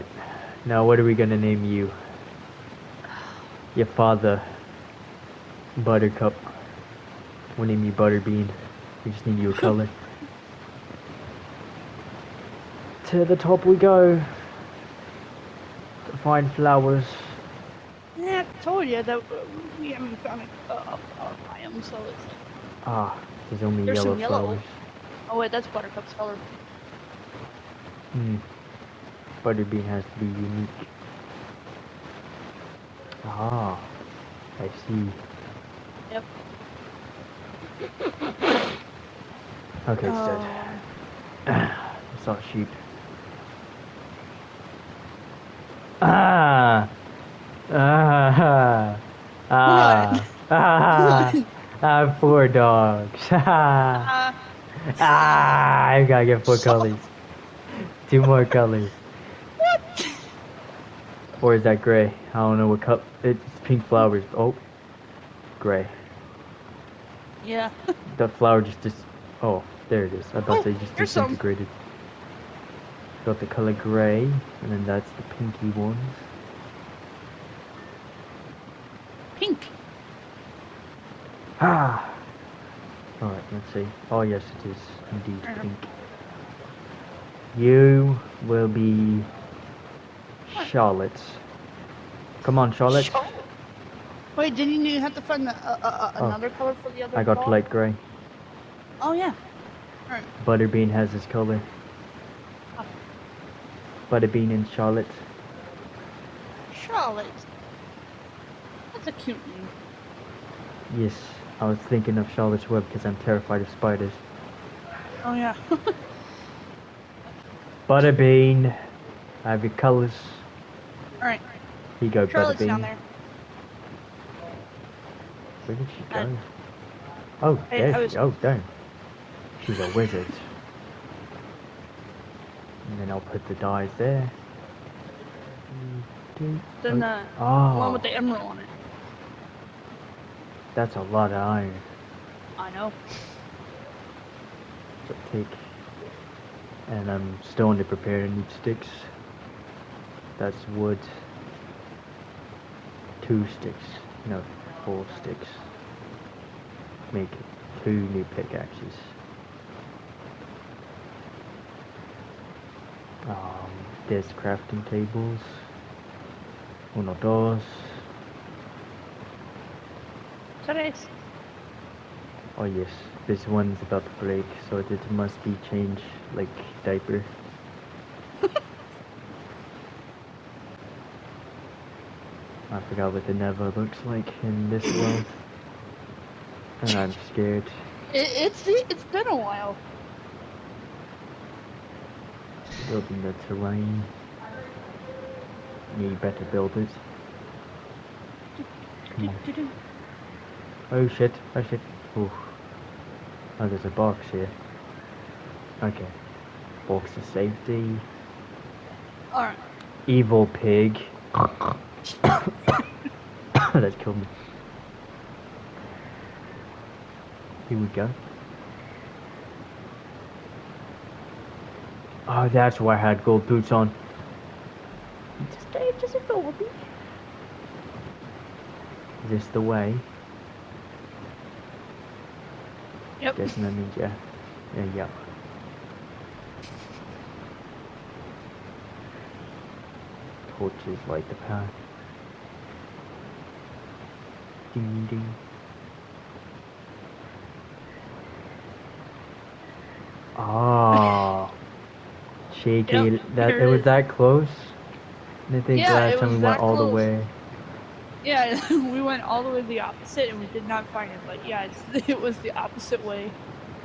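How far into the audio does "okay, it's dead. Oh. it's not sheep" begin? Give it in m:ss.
0:39.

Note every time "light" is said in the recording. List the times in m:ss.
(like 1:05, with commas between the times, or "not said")
1:37, 4:01.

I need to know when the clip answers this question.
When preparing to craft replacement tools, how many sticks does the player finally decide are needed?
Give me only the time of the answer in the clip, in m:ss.
2:34.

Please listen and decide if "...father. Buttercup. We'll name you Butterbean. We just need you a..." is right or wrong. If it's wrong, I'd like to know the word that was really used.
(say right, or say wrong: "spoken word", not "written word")
right.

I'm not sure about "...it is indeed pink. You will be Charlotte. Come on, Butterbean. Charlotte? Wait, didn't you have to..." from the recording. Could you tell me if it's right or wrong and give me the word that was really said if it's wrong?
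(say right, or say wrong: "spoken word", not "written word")
wrong: "Charlotte", not "Butterbean".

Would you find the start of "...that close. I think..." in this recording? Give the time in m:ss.
4:13.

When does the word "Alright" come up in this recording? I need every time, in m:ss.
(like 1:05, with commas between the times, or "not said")
2:01, 3:29.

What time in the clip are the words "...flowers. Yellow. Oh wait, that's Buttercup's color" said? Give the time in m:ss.
0:24.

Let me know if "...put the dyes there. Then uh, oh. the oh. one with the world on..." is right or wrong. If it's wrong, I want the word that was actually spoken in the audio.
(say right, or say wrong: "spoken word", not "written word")
wrong: "emerald", not "world".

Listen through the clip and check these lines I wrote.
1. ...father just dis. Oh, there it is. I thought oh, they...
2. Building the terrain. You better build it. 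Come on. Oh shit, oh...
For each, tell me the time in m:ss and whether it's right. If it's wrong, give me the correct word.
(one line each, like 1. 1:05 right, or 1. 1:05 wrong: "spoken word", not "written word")
1. 1:08 wrong: "flower", not "father"
2. 3:12 right.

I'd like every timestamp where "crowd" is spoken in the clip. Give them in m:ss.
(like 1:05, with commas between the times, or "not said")
not said.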